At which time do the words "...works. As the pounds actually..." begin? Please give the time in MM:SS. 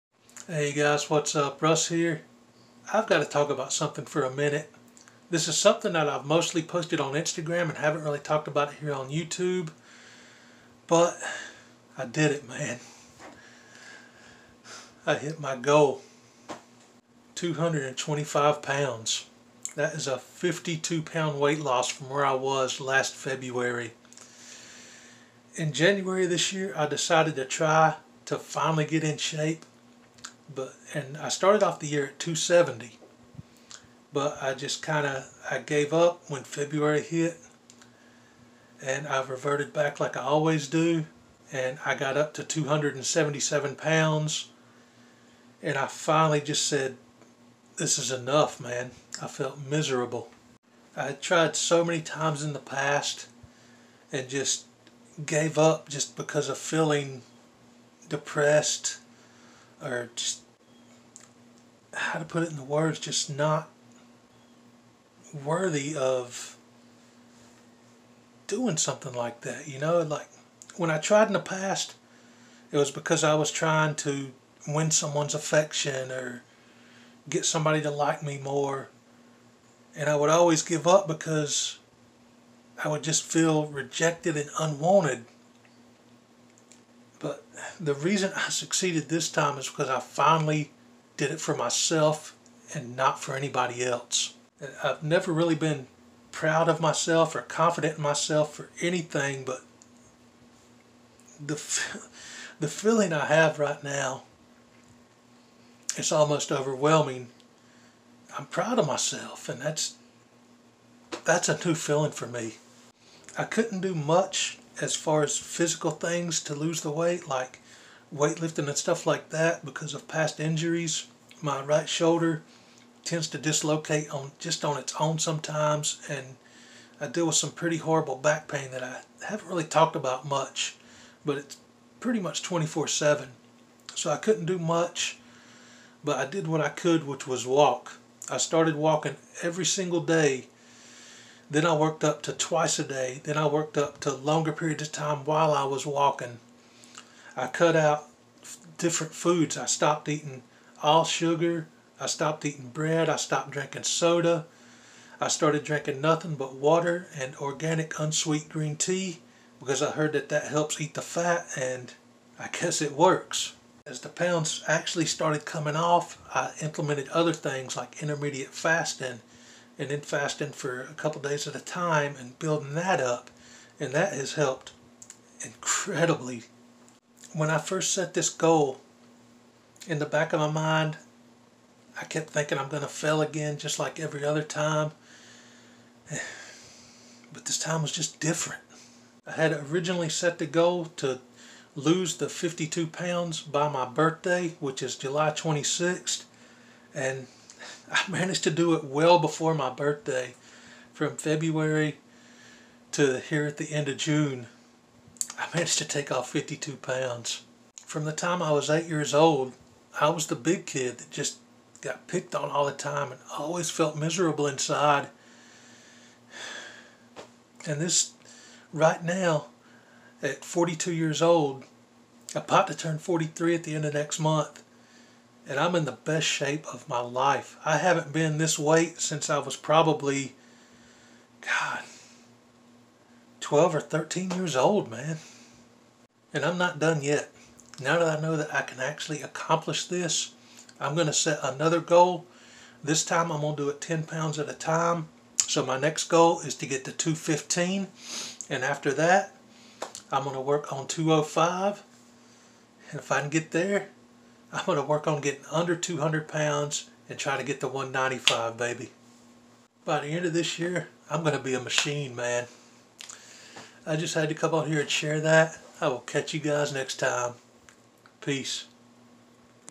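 02:42.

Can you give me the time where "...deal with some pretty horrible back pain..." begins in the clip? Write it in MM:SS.
02:07.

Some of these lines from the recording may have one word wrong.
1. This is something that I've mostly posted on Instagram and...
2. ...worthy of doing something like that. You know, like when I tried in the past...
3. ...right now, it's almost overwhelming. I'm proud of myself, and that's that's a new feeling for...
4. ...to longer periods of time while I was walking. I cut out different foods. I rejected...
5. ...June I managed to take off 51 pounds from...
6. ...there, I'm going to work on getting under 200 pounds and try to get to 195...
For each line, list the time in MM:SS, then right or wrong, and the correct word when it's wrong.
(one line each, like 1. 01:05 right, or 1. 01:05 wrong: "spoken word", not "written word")
1. 00:05 right
2. 01:05 right
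3. 01:43 right
4. 02:24 wrong: "stopped", not "rejected"
5. 03:23 wrong: "52", not "51"
6. 04:13 right.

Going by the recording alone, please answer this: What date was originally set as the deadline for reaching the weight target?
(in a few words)
July 26th.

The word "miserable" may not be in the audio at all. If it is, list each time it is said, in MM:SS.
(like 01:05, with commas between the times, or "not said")
00:49, 03:33.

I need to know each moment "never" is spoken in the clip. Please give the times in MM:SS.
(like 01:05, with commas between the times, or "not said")
01:35.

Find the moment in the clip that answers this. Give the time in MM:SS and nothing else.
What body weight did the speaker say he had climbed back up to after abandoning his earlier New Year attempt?
00:42.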